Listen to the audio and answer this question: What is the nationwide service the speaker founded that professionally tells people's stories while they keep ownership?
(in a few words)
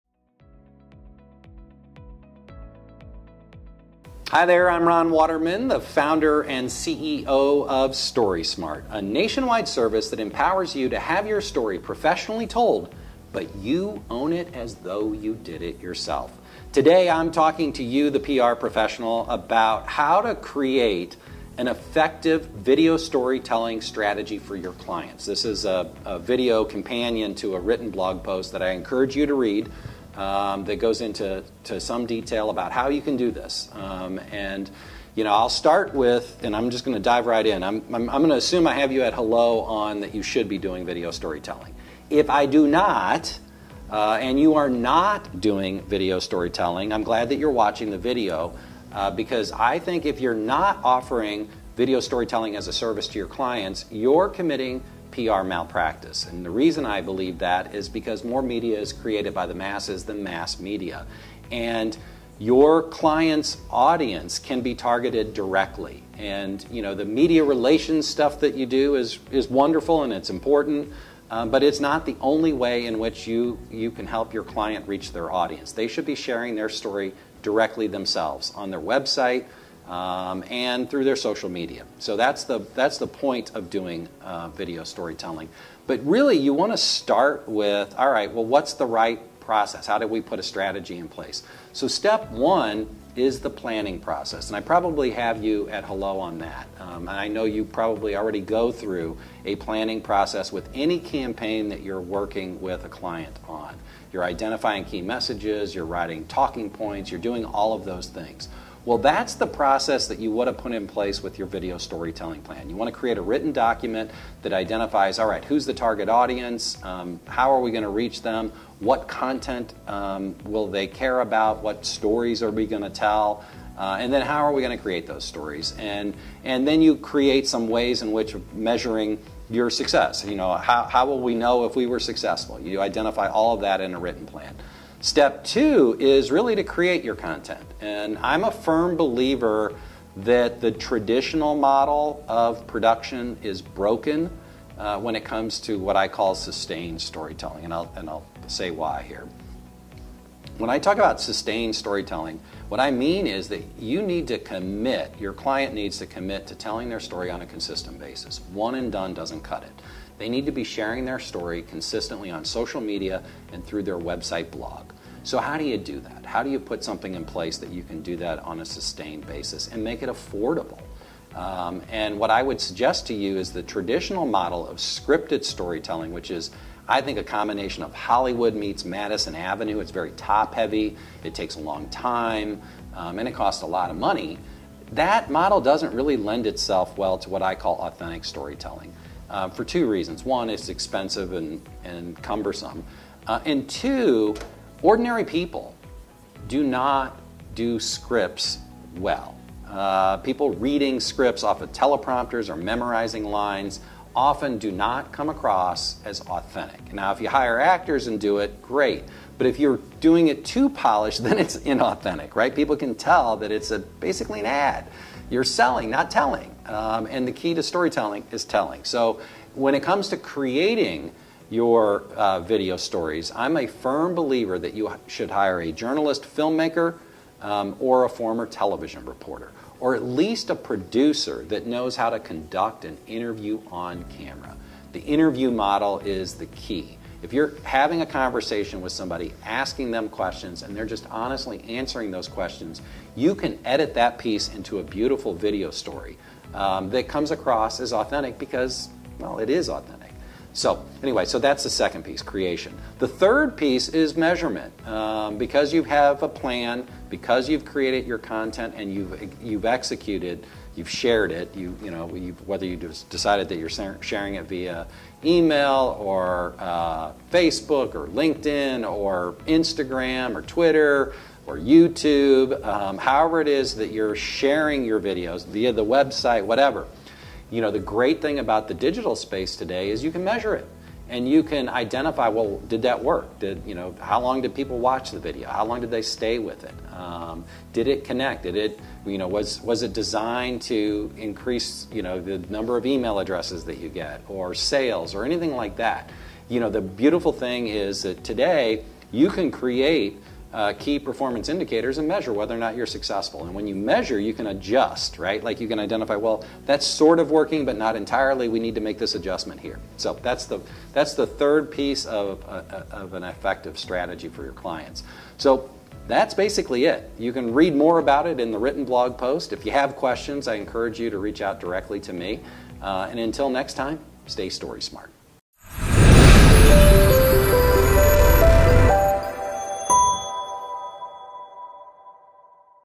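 StorySmart.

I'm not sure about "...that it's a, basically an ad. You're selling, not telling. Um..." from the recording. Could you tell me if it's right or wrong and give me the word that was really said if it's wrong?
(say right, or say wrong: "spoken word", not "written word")
right.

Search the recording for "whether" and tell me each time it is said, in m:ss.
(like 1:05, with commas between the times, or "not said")
4:22, 5:02.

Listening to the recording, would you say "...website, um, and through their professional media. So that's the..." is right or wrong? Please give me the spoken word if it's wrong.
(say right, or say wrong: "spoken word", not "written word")
wrong: "social", not "professional".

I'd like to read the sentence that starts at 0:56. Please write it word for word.
And the reason I believe that is because more media is created by the masses than mass media.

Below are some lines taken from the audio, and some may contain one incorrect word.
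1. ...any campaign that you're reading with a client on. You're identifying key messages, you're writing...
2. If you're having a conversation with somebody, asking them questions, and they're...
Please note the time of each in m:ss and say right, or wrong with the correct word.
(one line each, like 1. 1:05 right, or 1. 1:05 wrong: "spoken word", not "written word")
1. 1:40 wrong: "working", not "reading"
2. 3:57 right.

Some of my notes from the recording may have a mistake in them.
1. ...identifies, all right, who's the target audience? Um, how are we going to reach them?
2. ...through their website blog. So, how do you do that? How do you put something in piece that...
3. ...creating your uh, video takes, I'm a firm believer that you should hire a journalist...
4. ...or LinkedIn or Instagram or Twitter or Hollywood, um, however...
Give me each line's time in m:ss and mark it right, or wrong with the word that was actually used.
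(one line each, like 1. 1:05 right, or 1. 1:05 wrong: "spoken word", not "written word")
1. 1:54 right
2. 2:43 wrong: "place", not "piece"
3. 3:40 wrong: "stories", not "takes"
4. 4:27 wrong: "YouTube", not "Hollywood".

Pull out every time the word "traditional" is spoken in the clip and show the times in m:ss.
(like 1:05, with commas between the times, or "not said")
2:20, 2:53.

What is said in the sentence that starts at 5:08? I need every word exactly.
We need to make this adjustment here.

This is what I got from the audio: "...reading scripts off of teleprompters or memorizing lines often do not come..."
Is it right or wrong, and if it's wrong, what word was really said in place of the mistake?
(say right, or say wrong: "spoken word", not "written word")
right.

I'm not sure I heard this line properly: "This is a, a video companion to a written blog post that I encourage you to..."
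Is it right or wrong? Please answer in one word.
right.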